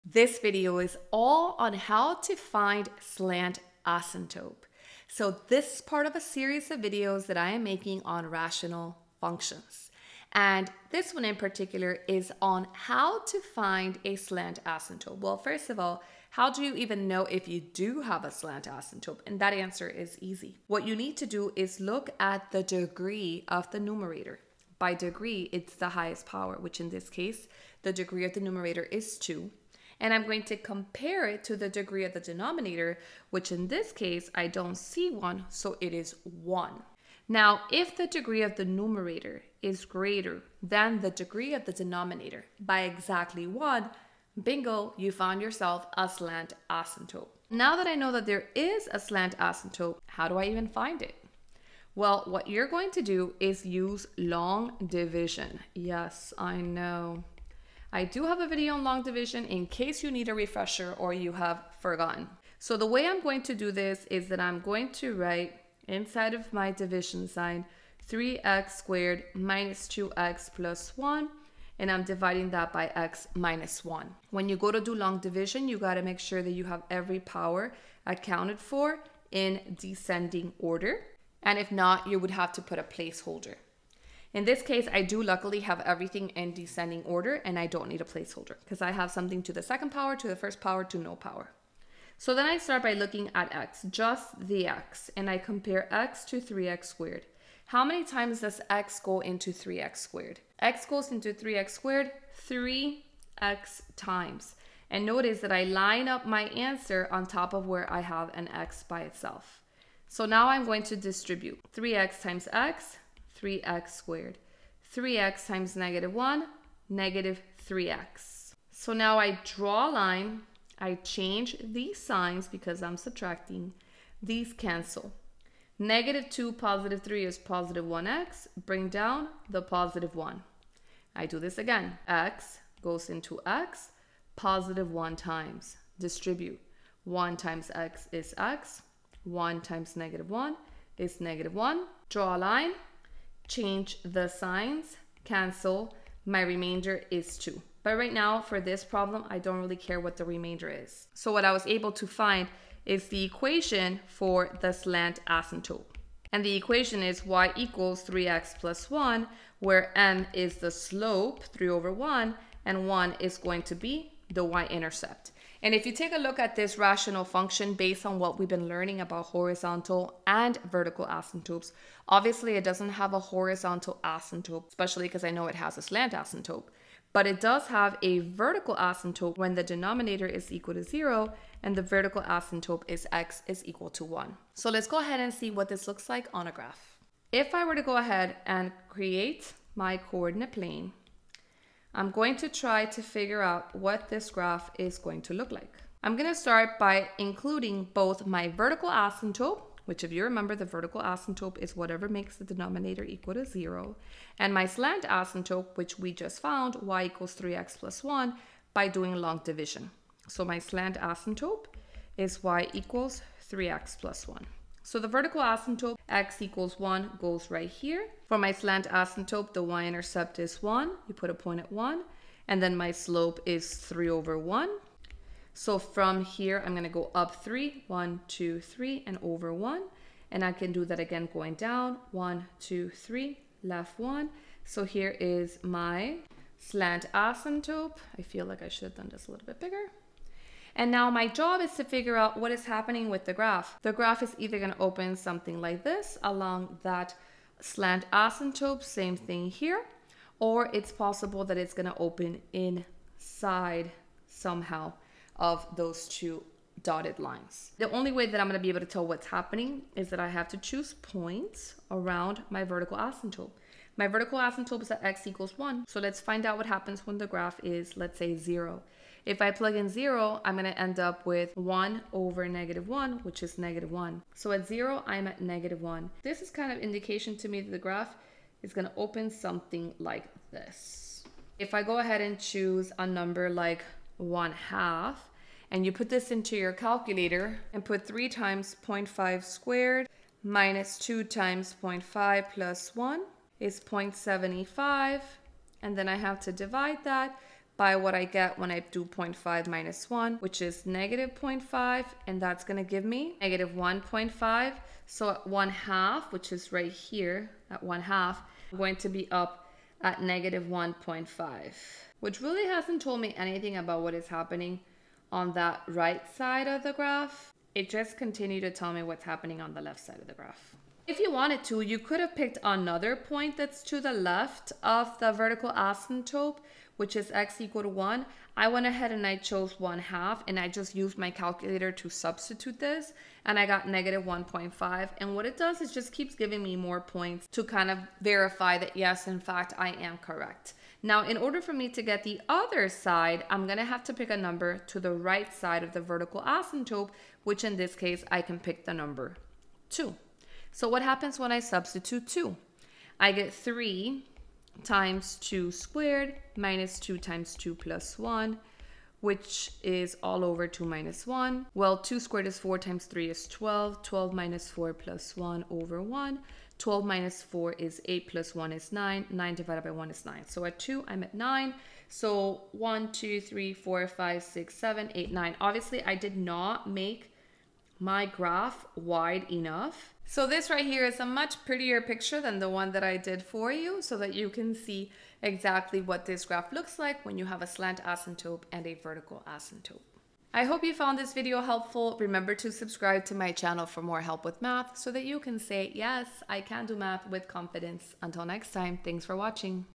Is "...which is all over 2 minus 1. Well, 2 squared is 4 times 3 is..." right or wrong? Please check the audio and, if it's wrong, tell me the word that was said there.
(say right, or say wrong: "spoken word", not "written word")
right.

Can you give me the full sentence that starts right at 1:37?
How many times does x go into 3x squared?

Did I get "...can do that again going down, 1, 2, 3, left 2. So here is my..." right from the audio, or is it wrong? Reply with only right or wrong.
wrong.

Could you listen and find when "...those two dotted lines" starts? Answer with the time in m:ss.
4:15.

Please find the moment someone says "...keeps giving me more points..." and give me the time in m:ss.
5:36.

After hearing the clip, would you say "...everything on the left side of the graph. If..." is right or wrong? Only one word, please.
wrong.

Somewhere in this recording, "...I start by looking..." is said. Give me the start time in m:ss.
1:32.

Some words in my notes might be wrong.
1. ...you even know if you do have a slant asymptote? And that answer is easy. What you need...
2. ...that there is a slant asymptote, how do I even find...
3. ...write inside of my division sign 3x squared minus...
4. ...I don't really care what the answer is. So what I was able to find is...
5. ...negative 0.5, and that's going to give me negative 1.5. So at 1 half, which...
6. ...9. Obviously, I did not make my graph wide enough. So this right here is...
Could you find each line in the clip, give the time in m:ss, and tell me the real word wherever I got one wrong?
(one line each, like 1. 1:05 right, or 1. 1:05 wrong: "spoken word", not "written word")
1. 0:16 right
2. 0:48 right
3. 1:05 right
4. 2:29 wrong: "remainder", not "answer"
5. 5:00 right
6. 6:15 right.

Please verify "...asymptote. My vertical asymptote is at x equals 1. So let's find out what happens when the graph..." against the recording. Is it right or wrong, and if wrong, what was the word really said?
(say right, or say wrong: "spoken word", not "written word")
right.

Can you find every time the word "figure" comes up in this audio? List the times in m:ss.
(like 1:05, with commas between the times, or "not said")
3:13, 4:01.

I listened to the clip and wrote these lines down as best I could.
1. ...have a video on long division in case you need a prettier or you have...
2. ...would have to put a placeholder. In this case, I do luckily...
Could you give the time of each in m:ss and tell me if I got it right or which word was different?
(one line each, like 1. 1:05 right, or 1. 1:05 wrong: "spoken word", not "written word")
1. 0:58 wrong: "refresher", not "prettier"
2. 1:22 right.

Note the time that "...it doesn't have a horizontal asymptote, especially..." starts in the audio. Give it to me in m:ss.
2:52.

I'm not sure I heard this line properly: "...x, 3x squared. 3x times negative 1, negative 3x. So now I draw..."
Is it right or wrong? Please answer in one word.
right.